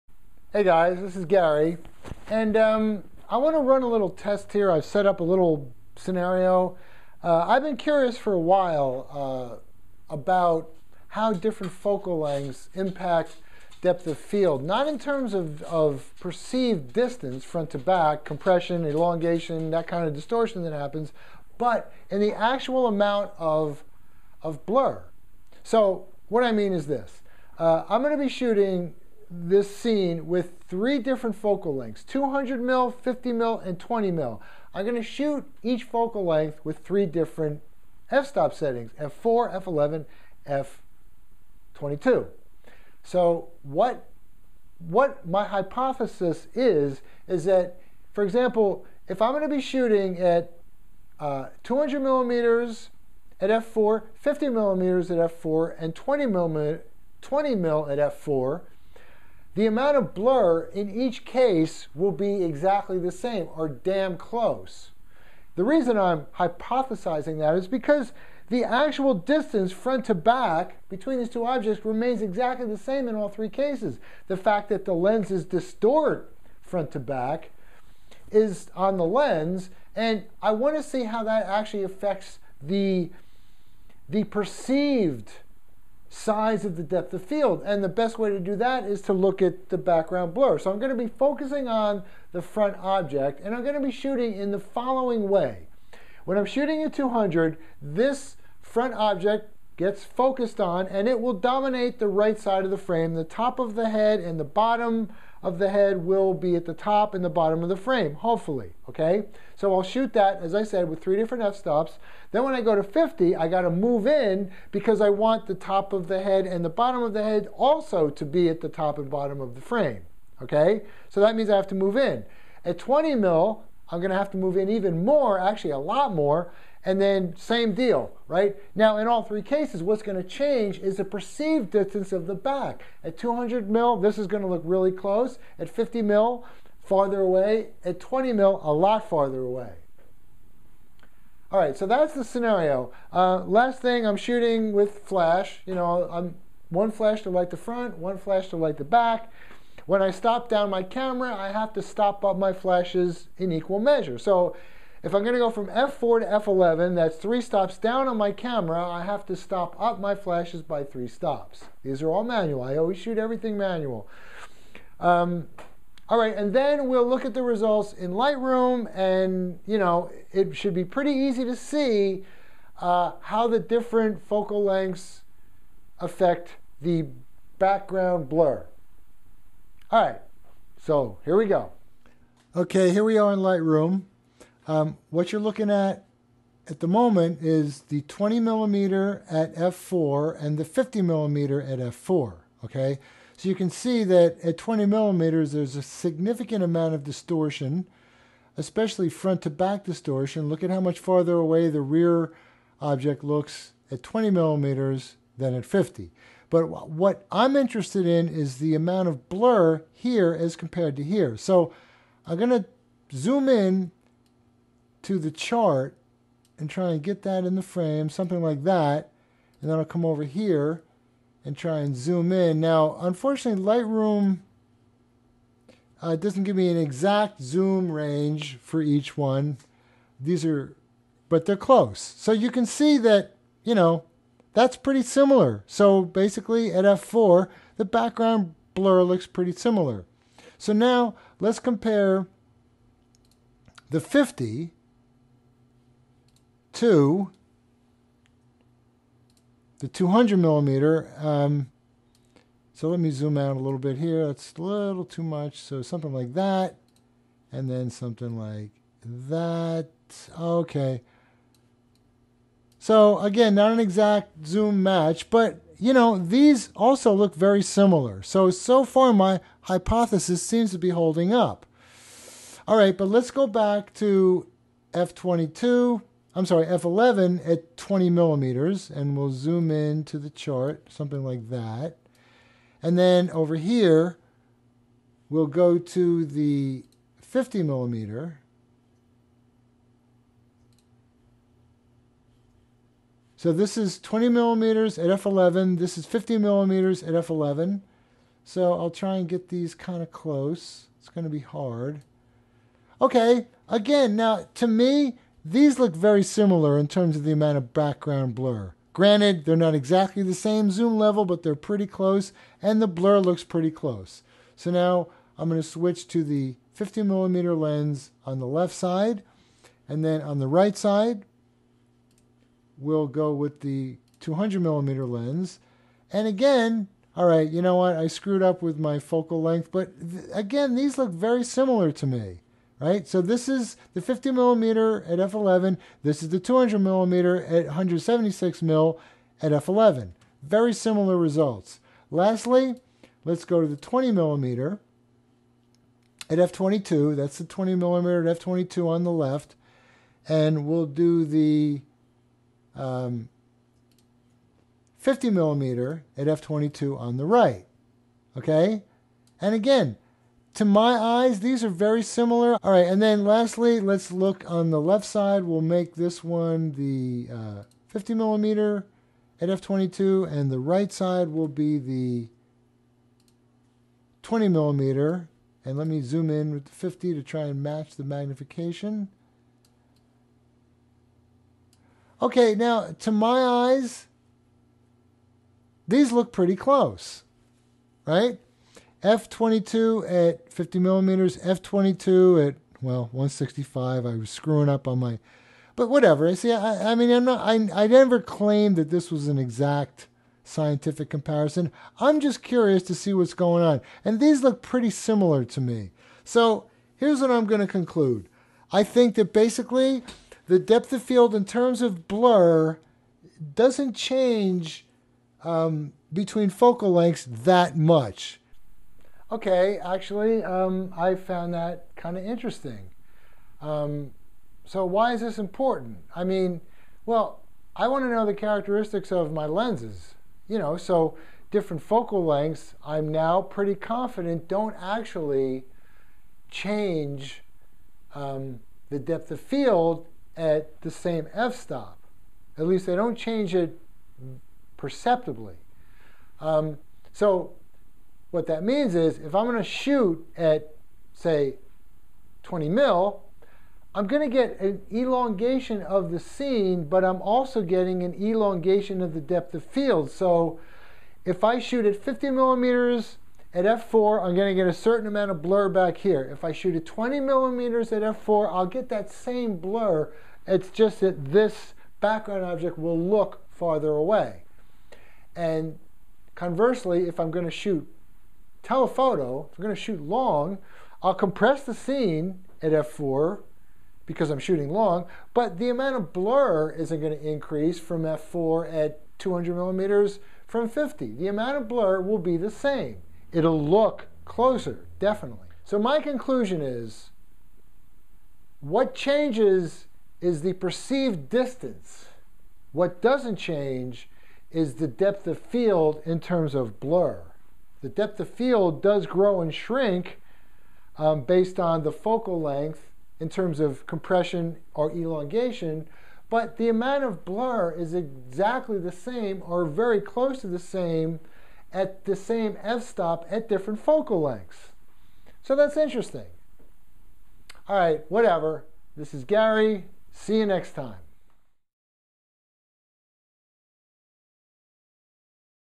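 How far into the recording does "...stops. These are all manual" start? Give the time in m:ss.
2:41.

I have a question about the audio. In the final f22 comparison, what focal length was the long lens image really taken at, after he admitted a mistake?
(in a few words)
165.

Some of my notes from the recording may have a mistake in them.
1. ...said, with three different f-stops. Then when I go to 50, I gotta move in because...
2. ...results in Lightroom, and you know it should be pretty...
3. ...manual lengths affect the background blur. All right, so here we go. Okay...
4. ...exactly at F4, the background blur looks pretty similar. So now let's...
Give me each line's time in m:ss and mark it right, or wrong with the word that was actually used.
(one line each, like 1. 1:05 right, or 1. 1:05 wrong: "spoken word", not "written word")
1. 1:50 right
2. 2:47 right
3. 2:54 wrong: "focal", not "manual"
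4. 3:56 wrong: "basically", not "exactly".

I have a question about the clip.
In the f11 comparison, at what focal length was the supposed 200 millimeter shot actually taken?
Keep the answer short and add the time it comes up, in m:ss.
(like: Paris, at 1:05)
176mm, at 5:37.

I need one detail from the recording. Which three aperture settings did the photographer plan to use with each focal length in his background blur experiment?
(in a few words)
f4, f11, f22.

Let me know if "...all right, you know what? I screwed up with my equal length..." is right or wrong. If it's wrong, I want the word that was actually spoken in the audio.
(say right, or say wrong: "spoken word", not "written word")
wrong: "focal", not "equal".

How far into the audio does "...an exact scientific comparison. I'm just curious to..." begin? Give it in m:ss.
6:39.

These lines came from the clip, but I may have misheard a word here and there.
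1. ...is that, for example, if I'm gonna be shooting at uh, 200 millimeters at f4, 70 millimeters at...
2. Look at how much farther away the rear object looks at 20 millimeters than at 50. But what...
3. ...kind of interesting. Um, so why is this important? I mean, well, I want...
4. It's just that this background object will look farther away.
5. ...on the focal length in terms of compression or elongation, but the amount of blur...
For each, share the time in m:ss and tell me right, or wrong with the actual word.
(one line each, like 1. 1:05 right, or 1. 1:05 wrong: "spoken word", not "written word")
1. 0:47 wrong: "50", not "70"
2. 3:20 right
3. 7:01 right
4. 7:50 right
5. 8:31 right.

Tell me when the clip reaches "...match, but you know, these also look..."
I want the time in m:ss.
4:24.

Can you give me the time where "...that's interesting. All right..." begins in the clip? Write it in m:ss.
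8:45.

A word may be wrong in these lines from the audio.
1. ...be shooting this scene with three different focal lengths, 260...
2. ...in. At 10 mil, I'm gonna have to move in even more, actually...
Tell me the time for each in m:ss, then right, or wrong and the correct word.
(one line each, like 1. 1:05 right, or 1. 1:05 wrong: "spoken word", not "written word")
1. 0:28 wrong: "200", not "260"
2. 2:01 wrong: "20", not "10".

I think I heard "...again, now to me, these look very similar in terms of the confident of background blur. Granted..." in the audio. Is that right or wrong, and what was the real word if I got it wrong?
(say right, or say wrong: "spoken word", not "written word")
wrong: "amount", not "confident".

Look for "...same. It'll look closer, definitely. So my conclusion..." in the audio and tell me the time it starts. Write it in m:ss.
8:12.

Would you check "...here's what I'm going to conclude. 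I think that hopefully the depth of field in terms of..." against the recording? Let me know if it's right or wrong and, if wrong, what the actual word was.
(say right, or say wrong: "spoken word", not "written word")
wrong: "basically", not "hopefully".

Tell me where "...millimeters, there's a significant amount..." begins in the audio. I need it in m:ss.
3:14.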